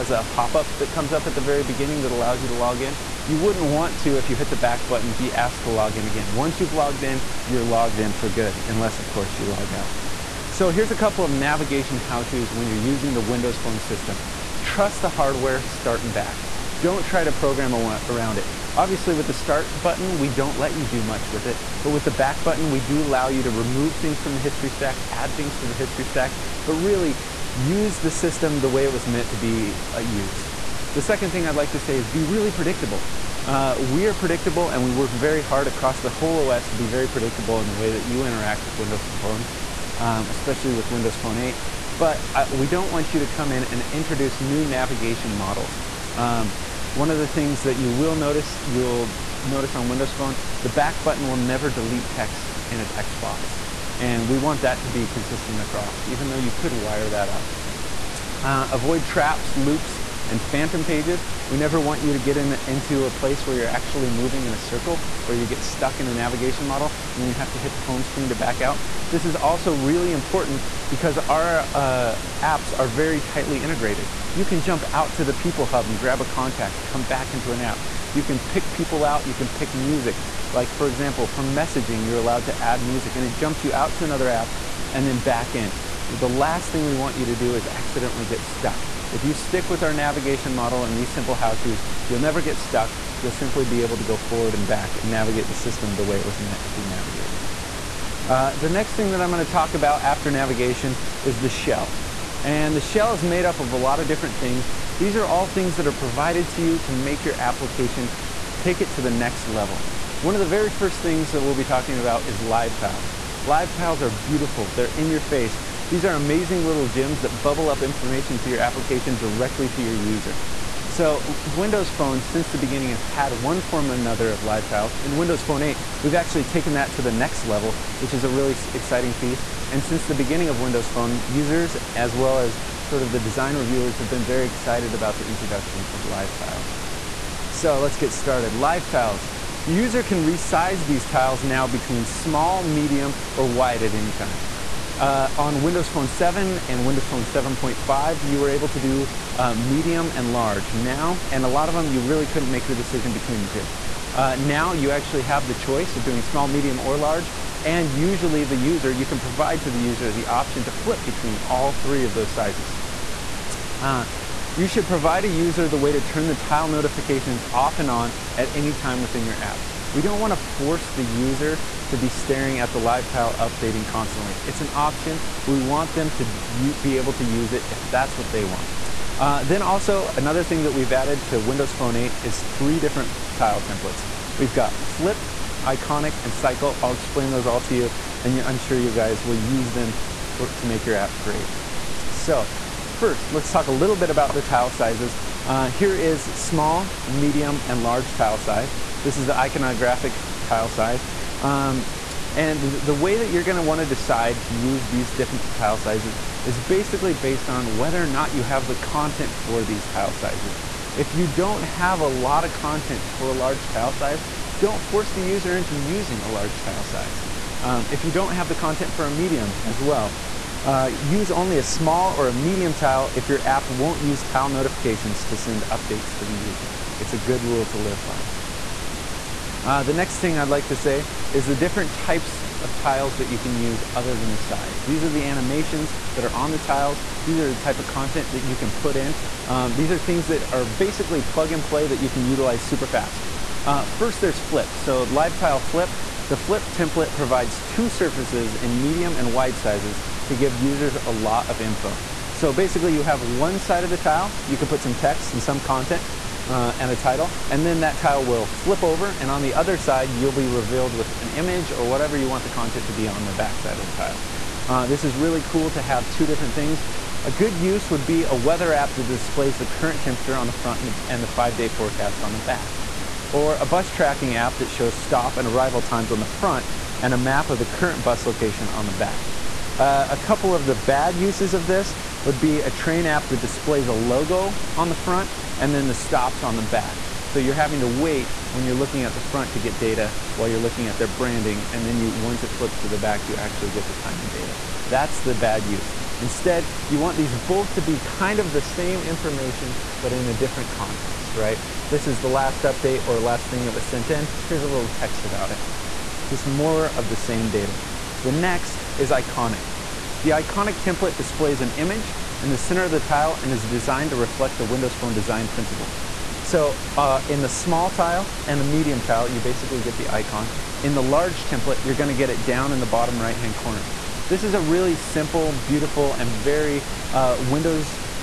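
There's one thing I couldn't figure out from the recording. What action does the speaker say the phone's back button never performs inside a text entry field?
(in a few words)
Delete text.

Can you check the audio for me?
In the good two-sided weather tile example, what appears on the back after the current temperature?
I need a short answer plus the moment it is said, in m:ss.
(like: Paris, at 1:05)
Five-day forecast, at 4:31.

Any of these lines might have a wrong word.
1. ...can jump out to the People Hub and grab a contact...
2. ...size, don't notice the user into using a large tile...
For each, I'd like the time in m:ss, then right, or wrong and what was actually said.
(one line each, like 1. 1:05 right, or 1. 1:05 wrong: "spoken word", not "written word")
1. 1:14 right
2. 3:33 wrong: "force", not "notice".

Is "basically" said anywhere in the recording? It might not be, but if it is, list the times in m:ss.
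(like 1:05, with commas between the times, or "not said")
3:26, 4:00, 4:12, 5:19.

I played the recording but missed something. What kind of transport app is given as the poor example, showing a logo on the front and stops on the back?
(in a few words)
Train app.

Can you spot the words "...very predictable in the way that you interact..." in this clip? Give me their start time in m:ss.
0:36.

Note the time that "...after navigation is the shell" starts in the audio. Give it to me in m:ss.
1:40.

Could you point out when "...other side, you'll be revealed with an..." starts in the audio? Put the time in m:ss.
4:19.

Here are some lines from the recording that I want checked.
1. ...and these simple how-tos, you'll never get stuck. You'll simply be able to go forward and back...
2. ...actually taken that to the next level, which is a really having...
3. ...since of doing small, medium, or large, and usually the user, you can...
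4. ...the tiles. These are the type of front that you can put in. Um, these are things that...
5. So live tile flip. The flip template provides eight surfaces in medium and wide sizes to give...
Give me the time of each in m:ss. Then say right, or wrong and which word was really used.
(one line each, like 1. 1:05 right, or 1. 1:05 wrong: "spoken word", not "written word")
1. 1:30 right
2. 2:06 wrong: "exciting", not "having"
3. 2:35 wrong: "choice", not "since"
4. 3:56 wrong: "content", not "front"
5. 4:04 wrong: "two", not "eight".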